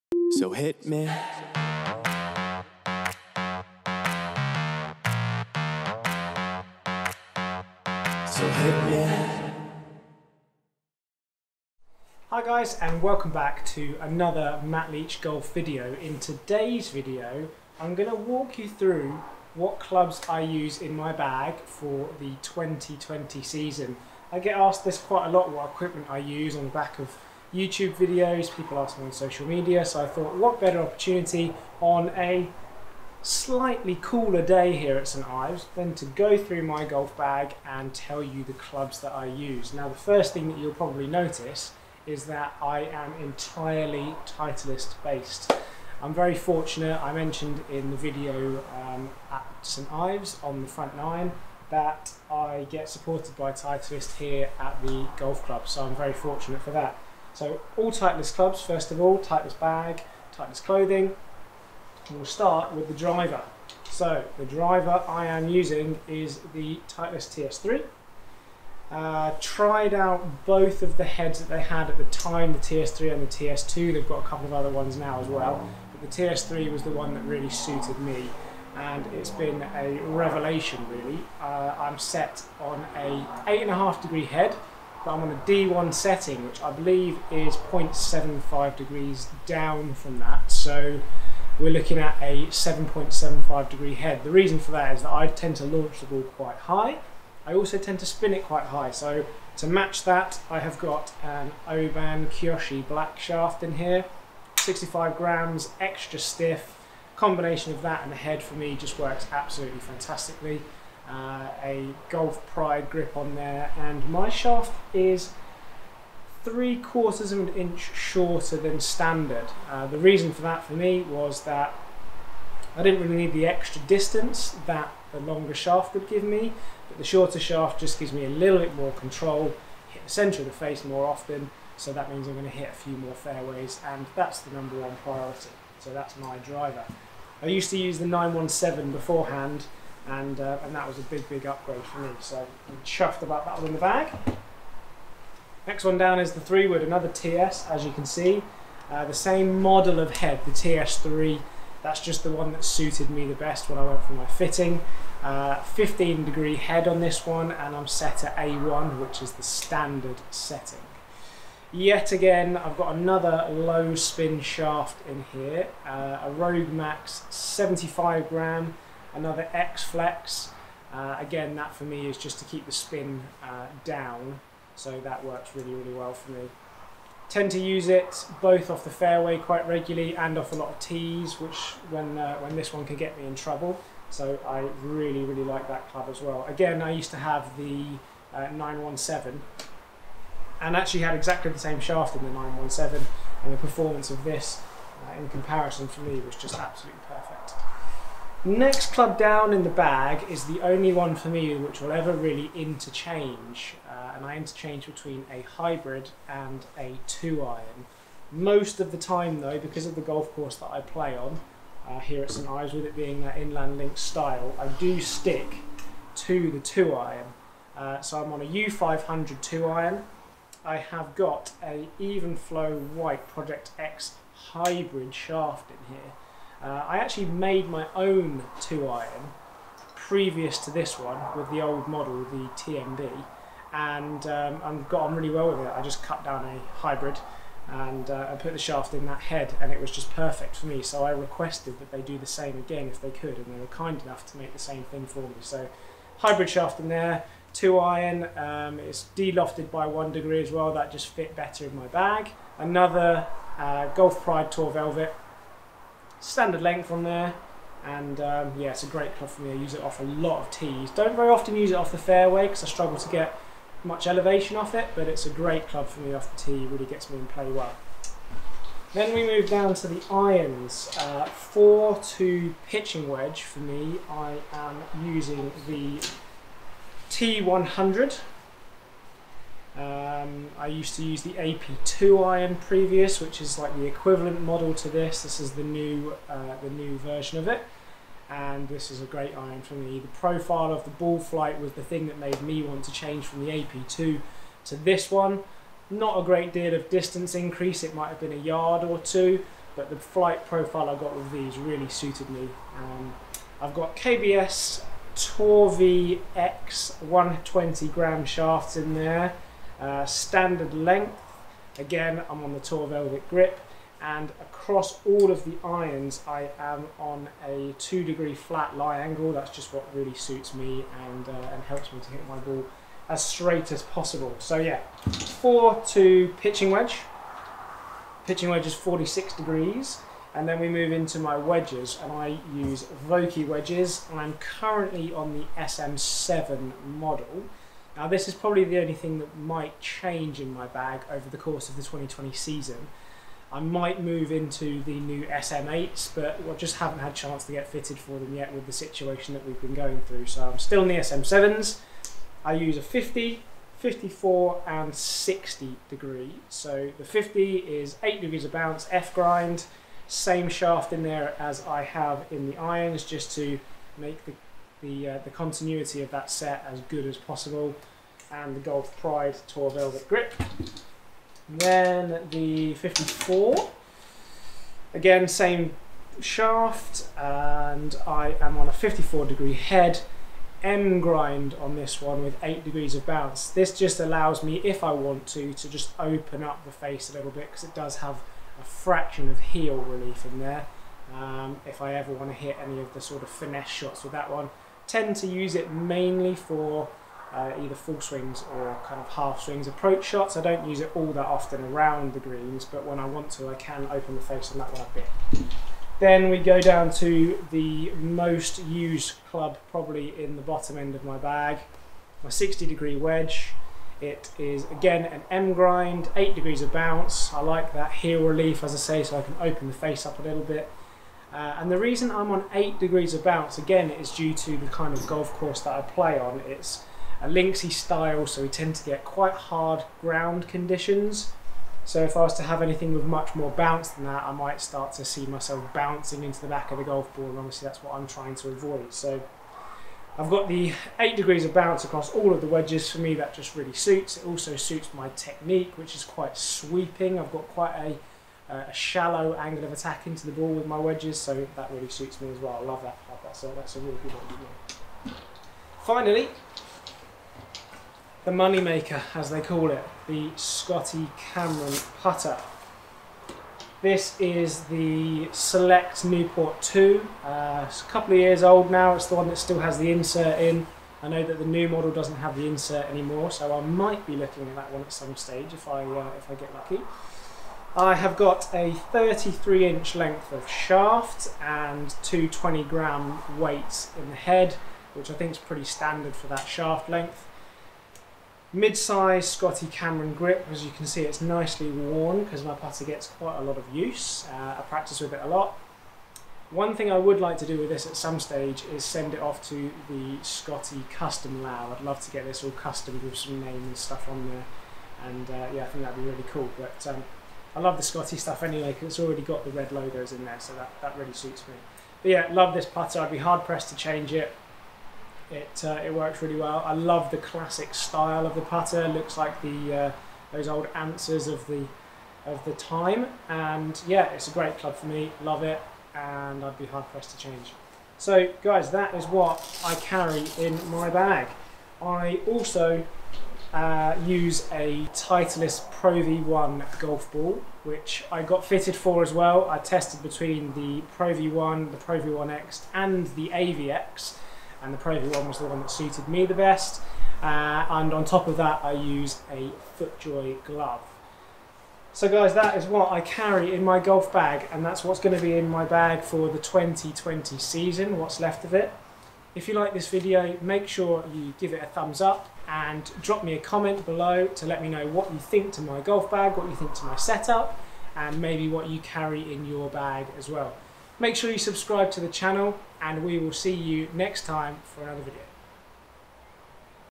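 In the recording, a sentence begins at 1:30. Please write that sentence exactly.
So we're looking at a 7.75 degree head.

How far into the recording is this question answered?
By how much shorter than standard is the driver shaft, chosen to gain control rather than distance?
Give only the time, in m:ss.
1:56.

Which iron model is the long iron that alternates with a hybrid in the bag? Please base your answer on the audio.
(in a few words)
U500.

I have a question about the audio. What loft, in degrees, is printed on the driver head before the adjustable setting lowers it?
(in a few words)
8.5.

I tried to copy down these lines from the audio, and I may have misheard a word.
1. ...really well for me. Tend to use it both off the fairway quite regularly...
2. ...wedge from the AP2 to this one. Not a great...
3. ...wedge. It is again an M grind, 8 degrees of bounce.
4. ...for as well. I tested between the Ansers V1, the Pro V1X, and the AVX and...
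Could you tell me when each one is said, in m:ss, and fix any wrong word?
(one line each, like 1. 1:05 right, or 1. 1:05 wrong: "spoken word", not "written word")
1. 2:55 right
2. 4:52 wrong: "change", not "wedge"
3. 6:52 right
4. 8:58 wrong: "Pro", not "Ansers".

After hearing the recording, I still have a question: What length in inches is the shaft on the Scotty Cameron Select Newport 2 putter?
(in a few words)
33.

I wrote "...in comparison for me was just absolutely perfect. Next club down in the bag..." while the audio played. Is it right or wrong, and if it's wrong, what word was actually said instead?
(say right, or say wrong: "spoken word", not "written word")
right.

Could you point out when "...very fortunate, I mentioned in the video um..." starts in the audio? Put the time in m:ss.
0:46.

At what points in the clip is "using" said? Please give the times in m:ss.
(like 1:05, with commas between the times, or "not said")
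1:05, 4:35.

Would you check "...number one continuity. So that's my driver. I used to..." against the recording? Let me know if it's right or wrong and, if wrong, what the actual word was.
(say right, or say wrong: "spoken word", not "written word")
wrong: "priority", not "continuity".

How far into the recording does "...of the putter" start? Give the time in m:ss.
8:38.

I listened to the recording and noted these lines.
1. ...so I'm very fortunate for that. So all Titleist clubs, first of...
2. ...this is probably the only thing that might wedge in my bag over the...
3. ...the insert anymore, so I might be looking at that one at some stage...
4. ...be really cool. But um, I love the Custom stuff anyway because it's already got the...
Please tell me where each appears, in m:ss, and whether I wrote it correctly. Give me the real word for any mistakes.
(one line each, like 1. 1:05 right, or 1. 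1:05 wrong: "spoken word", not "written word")
1. 0:55 right
2. 5:38 wrong: "change", not "wedge"
3. 7:52 right
4. 8:26 wrong: "Scotty", not "Custom".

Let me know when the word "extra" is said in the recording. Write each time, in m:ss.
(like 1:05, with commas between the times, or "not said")
1:45, 2:03.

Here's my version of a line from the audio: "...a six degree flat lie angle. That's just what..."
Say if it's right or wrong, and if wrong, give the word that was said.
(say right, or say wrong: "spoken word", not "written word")
wrong: "two", not "six".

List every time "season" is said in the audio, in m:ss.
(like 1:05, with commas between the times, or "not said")
0:23, 5:42, 9:17.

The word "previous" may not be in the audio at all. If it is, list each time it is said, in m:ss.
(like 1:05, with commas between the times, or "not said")
3:49, 4:42.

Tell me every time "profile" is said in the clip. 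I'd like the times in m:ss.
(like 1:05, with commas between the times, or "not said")
4:50, 5:00.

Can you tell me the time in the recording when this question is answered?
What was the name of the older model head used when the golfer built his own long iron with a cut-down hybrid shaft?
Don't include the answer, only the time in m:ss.
3:52.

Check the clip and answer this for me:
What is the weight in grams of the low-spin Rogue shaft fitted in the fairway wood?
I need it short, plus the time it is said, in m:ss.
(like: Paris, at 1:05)
75, at 2:46.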